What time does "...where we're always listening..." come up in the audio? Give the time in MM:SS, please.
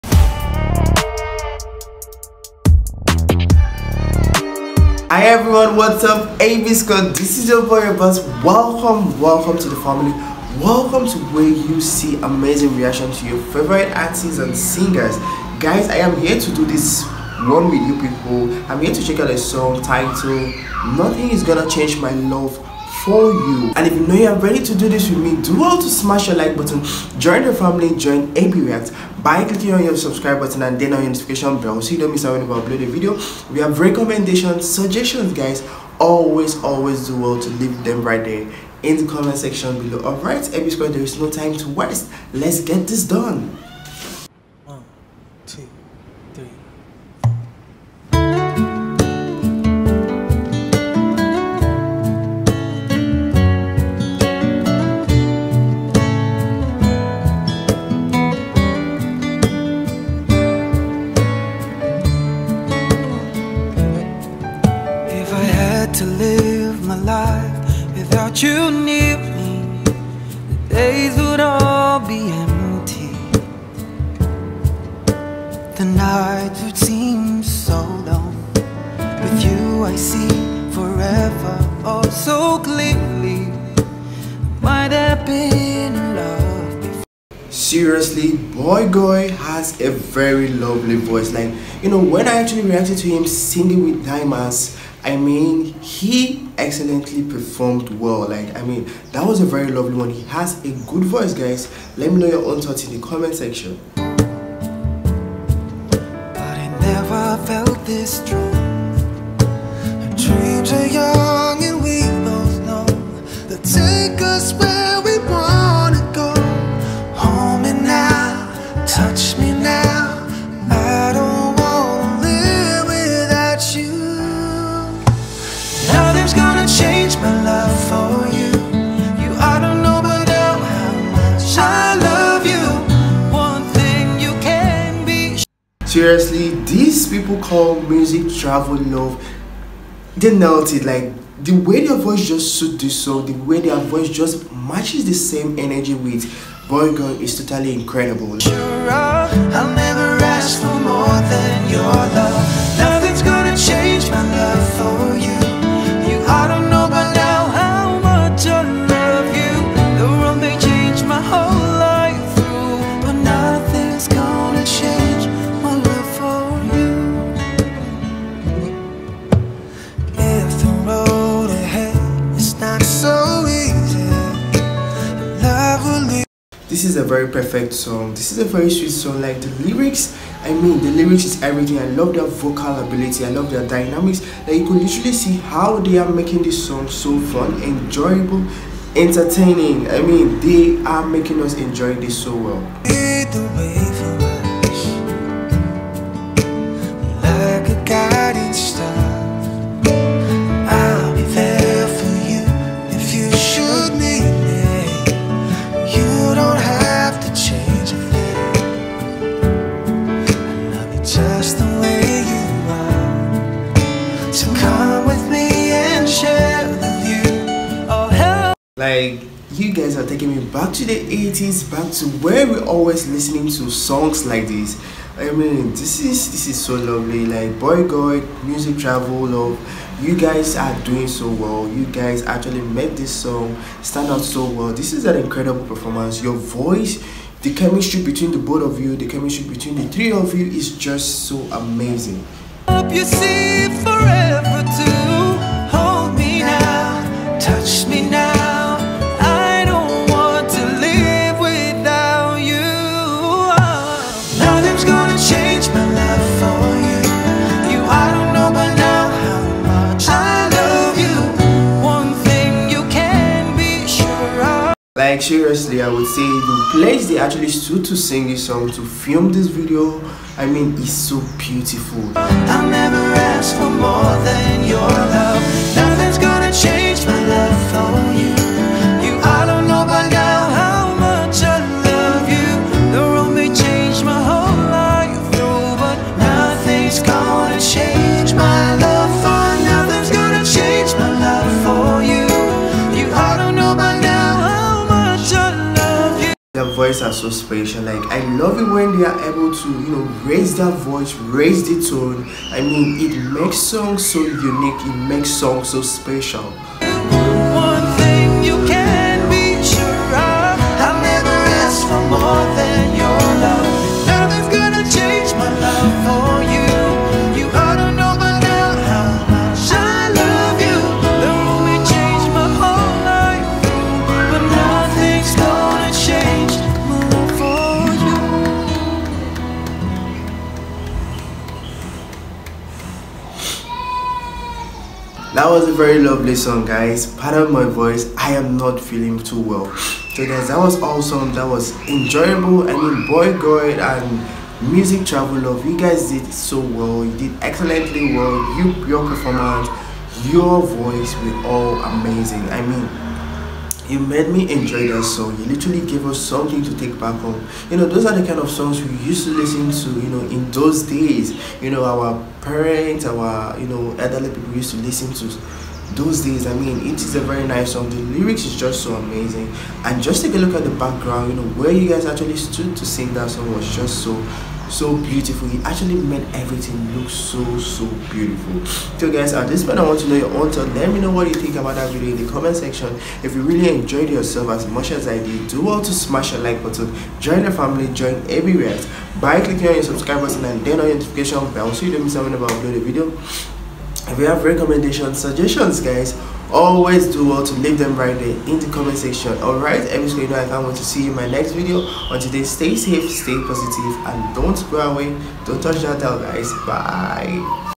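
03:42.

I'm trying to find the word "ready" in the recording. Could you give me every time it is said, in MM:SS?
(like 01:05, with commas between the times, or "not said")
00:24.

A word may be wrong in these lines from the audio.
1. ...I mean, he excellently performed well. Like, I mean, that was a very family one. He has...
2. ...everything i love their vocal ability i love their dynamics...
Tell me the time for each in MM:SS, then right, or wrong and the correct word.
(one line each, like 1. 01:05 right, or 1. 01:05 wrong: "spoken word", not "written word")
1. 01:35 wrong: "lovely", not "family"
2. 03:01 right.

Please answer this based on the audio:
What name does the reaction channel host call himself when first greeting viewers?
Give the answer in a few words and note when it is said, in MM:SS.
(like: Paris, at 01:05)
Abbas, at 00:07.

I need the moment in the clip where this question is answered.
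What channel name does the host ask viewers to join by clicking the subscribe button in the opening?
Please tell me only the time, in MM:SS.
00:28.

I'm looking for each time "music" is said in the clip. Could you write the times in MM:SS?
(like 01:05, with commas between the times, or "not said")
02:17, 03:48, 05:44.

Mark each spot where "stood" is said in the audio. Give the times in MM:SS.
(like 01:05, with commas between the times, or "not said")
04:27, 06:12.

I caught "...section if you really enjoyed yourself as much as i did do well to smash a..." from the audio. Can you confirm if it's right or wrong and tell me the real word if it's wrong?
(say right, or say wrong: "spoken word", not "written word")
right.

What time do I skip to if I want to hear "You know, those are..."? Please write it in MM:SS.
05:57.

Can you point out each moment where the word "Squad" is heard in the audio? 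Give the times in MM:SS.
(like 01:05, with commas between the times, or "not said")
00:06, 00:40.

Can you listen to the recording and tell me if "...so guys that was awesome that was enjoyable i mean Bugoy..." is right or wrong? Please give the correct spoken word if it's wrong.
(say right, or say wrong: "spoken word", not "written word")
right.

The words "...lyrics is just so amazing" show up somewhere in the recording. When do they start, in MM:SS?
06:07.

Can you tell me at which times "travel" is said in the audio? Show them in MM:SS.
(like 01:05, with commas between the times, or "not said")
02:18, 03:48, 05:45.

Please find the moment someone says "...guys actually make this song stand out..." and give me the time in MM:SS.
03:51.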